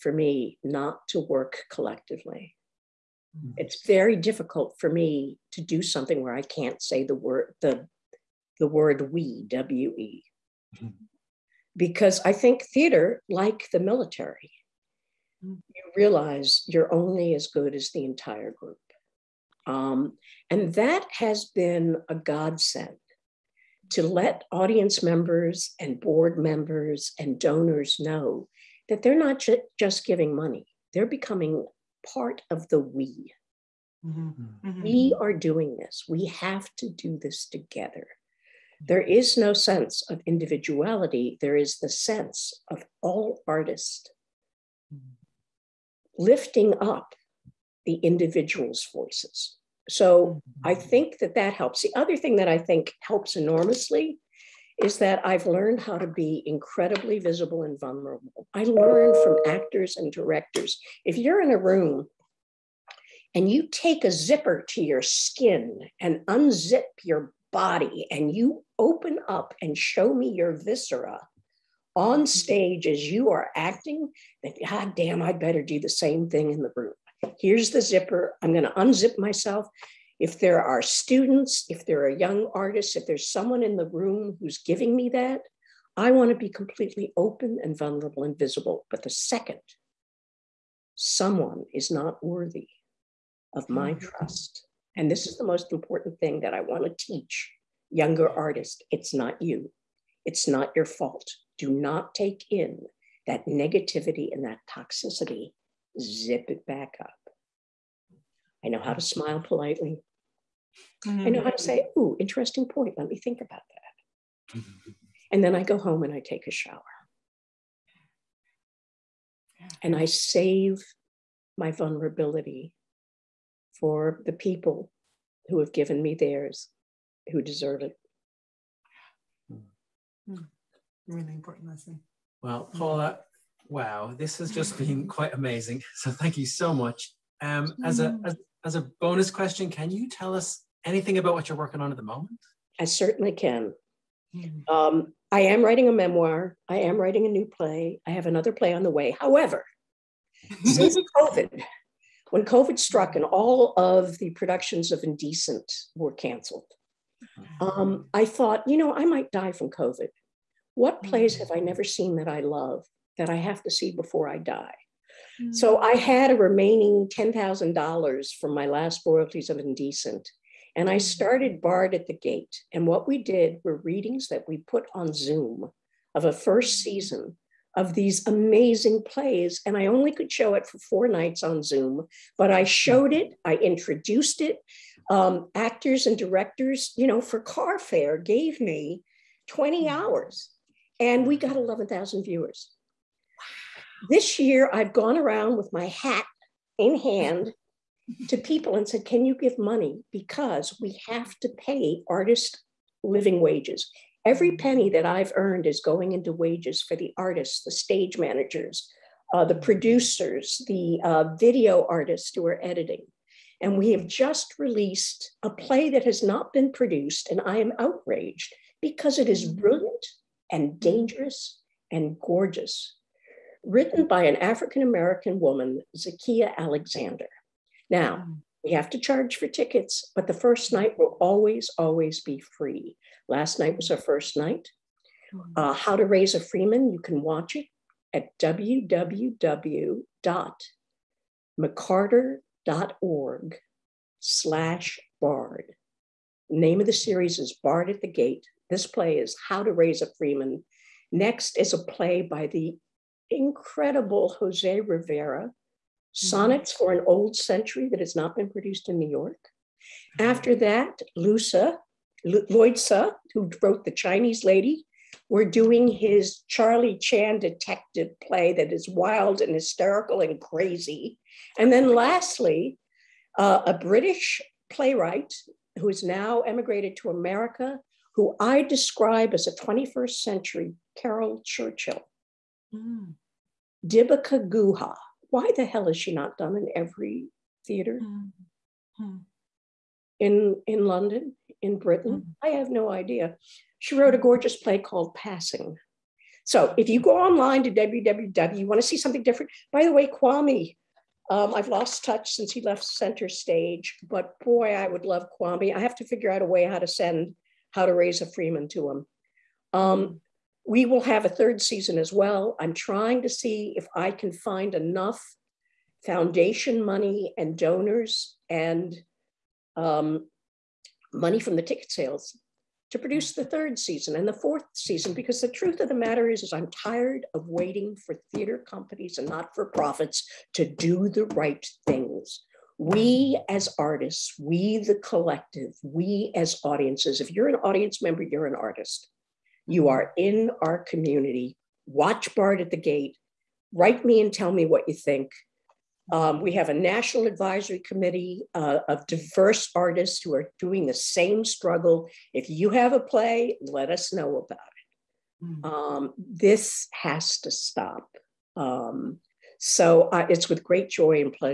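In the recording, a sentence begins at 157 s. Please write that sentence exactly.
um, I thought, you know, I might die from COVID.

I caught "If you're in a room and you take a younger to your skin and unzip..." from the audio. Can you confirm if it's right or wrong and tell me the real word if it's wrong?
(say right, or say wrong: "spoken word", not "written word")
wrong: "zipper", not "younger".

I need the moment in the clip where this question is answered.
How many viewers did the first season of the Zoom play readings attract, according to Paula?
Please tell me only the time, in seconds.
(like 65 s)
191 s.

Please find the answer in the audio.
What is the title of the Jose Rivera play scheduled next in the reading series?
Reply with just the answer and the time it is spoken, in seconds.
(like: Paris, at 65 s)
Sonnets for an Old Century, at 256 s.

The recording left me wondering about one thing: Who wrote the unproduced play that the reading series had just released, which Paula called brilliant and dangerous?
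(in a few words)
Zakiyyah Alexander.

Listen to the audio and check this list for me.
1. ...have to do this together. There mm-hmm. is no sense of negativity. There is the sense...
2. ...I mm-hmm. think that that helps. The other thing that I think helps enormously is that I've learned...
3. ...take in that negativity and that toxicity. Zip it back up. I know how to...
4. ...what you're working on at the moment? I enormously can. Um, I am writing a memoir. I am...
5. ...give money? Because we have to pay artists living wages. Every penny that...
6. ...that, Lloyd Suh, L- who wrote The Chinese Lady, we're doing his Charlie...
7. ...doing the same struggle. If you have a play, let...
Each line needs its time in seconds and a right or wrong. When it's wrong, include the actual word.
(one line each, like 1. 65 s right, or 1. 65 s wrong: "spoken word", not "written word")
1. 36 s wrong: "individuality", not "negativity"
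2. 50 s right
3. 102 s right
4. 141 s wrong: "certainly", not "enormously"
5. 199 s right
6. 260 s right
7. 350 s right.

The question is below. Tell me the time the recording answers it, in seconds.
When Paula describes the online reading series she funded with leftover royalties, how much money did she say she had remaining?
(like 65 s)
167 s.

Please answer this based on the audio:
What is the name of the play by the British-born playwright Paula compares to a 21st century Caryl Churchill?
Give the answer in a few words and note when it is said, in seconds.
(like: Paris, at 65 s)
Passing, at 295 s.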